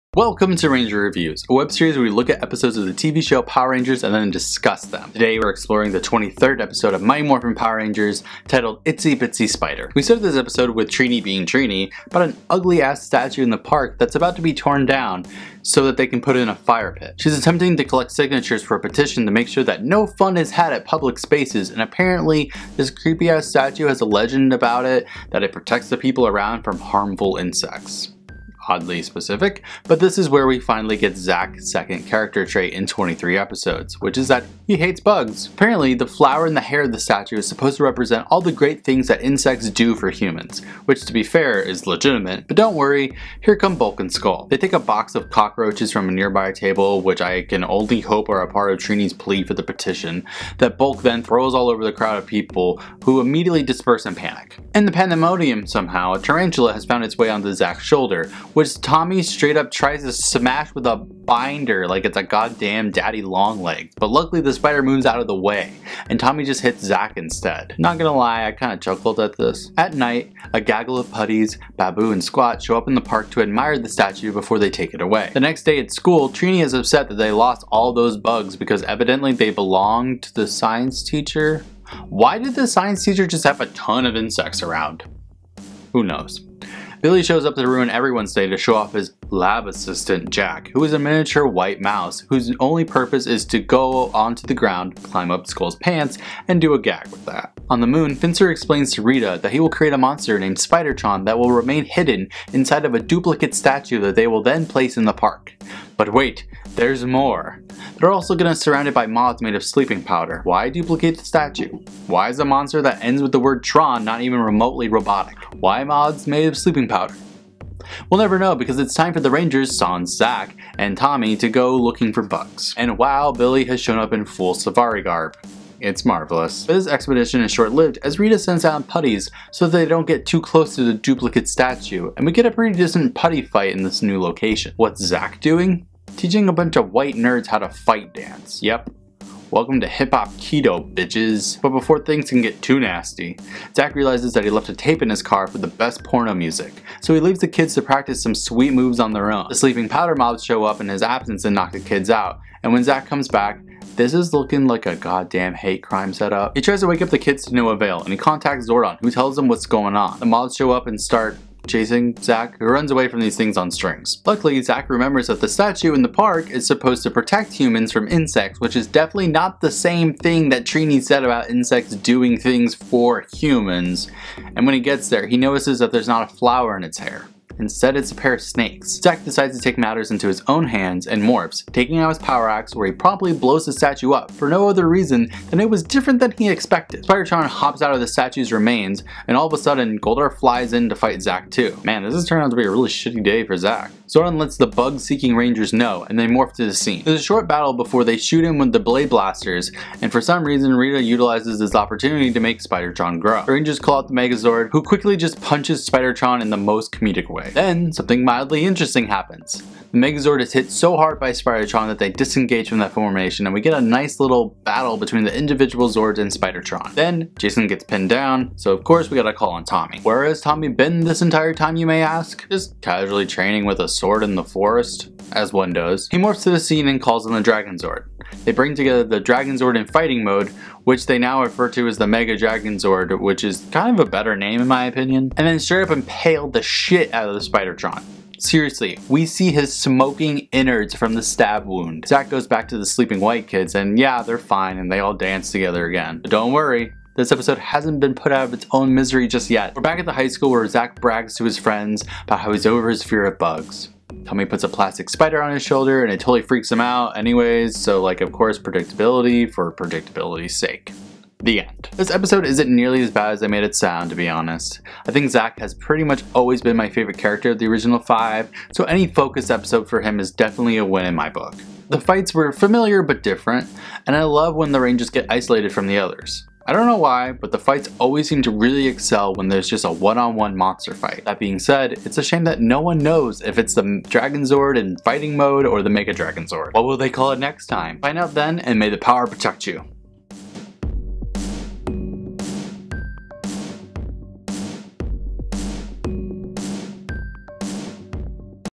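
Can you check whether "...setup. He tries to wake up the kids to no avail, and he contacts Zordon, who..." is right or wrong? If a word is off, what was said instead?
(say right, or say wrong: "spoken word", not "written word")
right.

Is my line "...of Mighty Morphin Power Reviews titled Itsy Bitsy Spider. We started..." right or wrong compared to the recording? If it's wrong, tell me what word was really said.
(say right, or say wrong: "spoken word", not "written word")
wrong: "Rangers", not "Reviews".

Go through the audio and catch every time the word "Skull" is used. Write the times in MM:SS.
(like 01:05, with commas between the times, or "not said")
00:44, 01:35.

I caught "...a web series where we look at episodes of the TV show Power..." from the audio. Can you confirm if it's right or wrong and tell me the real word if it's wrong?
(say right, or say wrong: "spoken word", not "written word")
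right.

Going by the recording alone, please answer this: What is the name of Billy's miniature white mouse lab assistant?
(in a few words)
Jack.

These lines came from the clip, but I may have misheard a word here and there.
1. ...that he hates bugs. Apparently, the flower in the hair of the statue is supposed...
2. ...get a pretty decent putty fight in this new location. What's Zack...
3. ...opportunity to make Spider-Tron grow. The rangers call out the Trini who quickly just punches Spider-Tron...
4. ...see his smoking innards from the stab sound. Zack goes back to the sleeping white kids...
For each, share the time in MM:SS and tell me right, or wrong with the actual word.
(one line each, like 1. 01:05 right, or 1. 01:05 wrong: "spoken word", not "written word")
1. 00:34 right
2. 02:12 right
3. 03:21 wrong: "Megazord", not "Trini"
4. 03:59 wrong: "wound", not "sound".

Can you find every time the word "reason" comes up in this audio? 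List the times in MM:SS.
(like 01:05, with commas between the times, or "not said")
03:04, 03:20.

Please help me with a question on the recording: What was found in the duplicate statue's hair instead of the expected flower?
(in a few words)
A pair of snakes.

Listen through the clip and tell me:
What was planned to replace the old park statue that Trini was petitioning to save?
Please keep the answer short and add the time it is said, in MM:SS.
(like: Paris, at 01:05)
A fire pit, at 00:16.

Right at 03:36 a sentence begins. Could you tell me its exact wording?
Then Jason gets pinned down so of course we gotta call on Tommy.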